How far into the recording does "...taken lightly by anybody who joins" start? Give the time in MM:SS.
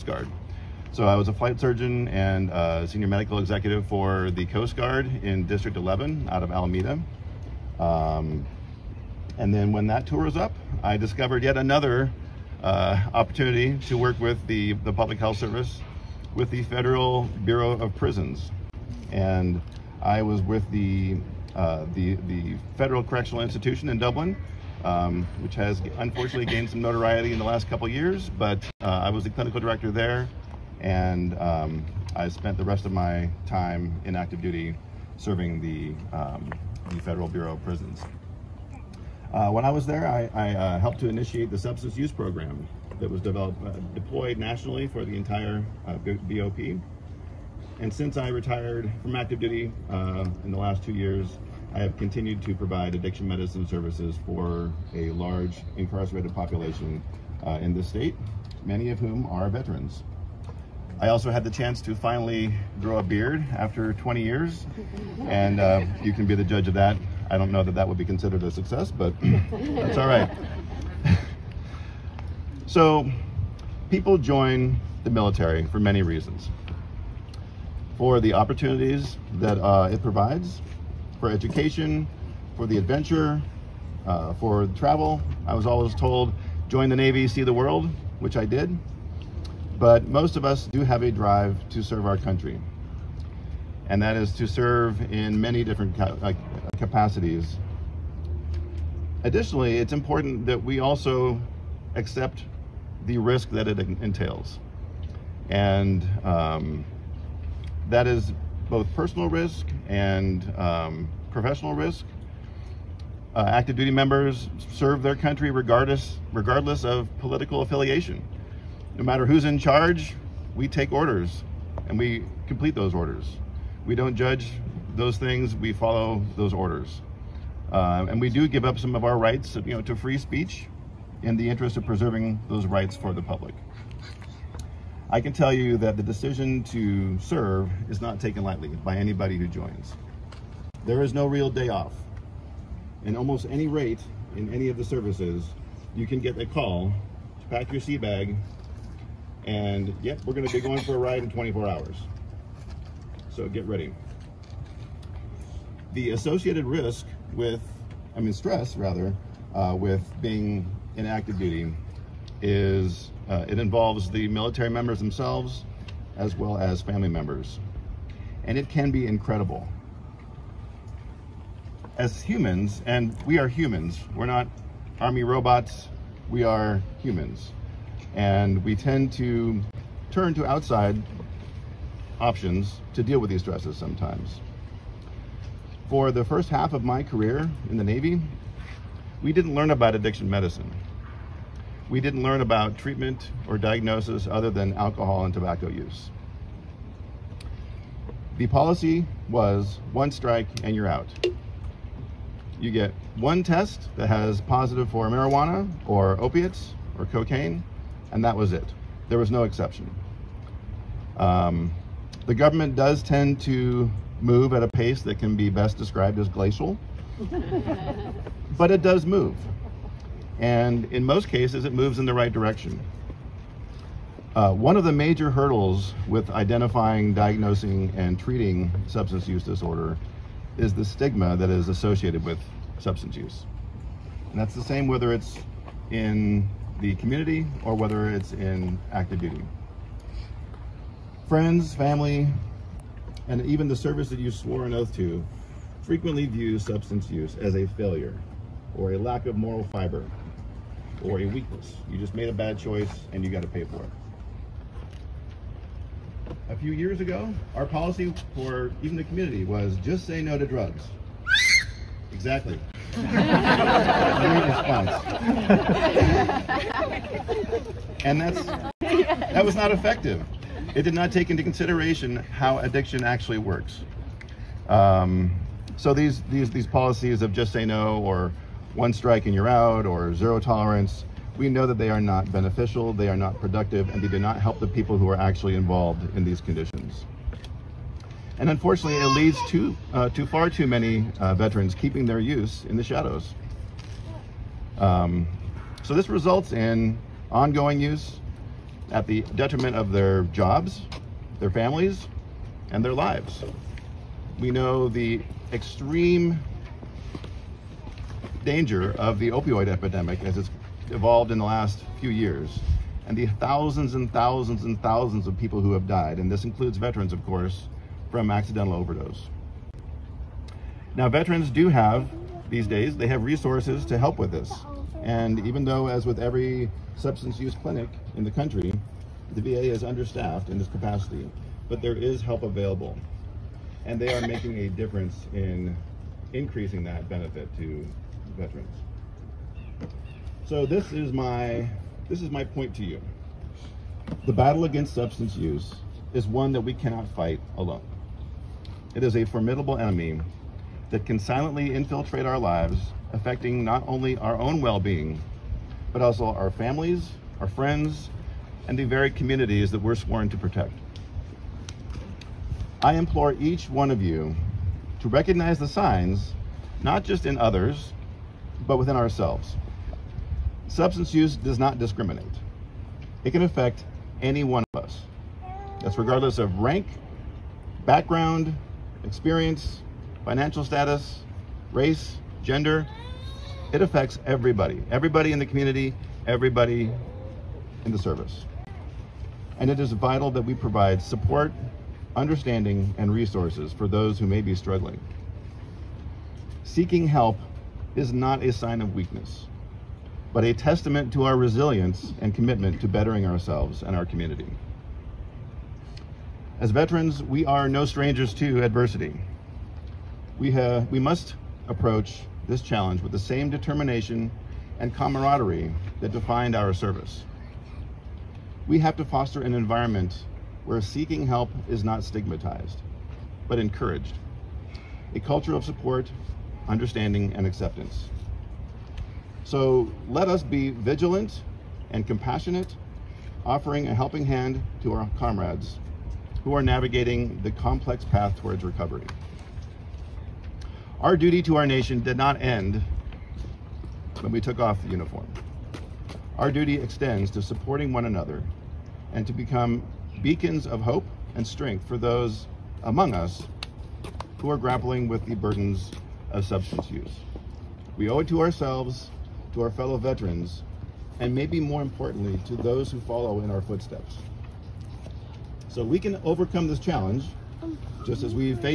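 02:18.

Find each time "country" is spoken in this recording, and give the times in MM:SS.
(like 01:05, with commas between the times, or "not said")
01:32, 01:55, 05:28.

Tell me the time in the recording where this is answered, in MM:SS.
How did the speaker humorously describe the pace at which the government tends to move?
03:36.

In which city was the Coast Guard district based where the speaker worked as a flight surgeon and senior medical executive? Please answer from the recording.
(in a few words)
Alameda.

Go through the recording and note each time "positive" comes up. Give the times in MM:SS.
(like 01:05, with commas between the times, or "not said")
03:24.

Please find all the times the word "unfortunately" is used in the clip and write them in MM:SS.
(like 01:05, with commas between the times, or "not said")
00:25, 04:48.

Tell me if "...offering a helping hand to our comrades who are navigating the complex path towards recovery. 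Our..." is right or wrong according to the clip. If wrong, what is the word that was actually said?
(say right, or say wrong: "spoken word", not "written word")
right.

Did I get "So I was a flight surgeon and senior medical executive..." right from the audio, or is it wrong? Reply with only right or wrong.
right.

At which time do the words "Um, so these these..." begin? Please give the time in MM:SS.
04:34.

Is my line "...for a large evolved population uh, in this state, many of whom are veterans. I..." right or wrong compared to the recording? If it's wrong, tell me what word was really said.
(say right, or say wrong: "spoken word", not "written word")
wrong: "incarcerated", not "evolved".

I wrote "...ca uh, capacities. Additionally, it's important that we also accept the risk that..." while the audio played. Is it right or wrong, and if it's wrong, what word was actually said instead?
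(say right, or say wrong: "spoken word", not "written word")
right.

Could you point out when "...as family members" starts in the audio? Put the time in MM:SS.
02:46.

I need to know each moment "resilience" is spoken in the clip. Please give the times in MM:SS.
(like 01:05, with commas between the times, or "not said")
06:41.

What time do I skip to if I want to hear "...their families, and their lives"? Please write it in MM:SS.
05:01.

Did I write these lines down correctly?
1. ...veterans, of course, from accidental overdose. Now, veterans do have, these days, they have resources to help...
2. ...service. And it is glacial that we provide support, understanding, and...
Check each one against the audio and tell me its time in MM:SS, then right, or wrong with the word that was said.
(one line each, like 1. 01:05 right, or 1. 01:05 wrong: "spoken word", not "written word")
1. 05:16 right
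2. 06:27 wrong: "vital", not "glacial".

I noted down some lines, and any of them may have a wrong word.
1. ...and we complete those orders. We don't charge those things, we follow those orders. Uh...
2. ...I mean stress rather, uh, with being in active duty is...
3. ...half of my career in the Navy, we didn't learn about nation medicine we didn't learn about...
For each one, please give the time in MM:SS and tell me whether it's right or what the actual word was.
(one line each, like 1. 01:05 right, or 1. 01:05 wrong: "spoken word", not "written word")
1. 02:01 wrong: "judge", not "charge"
2. 02:38 right
3. 03:06 wrong: "addiction", not "nation".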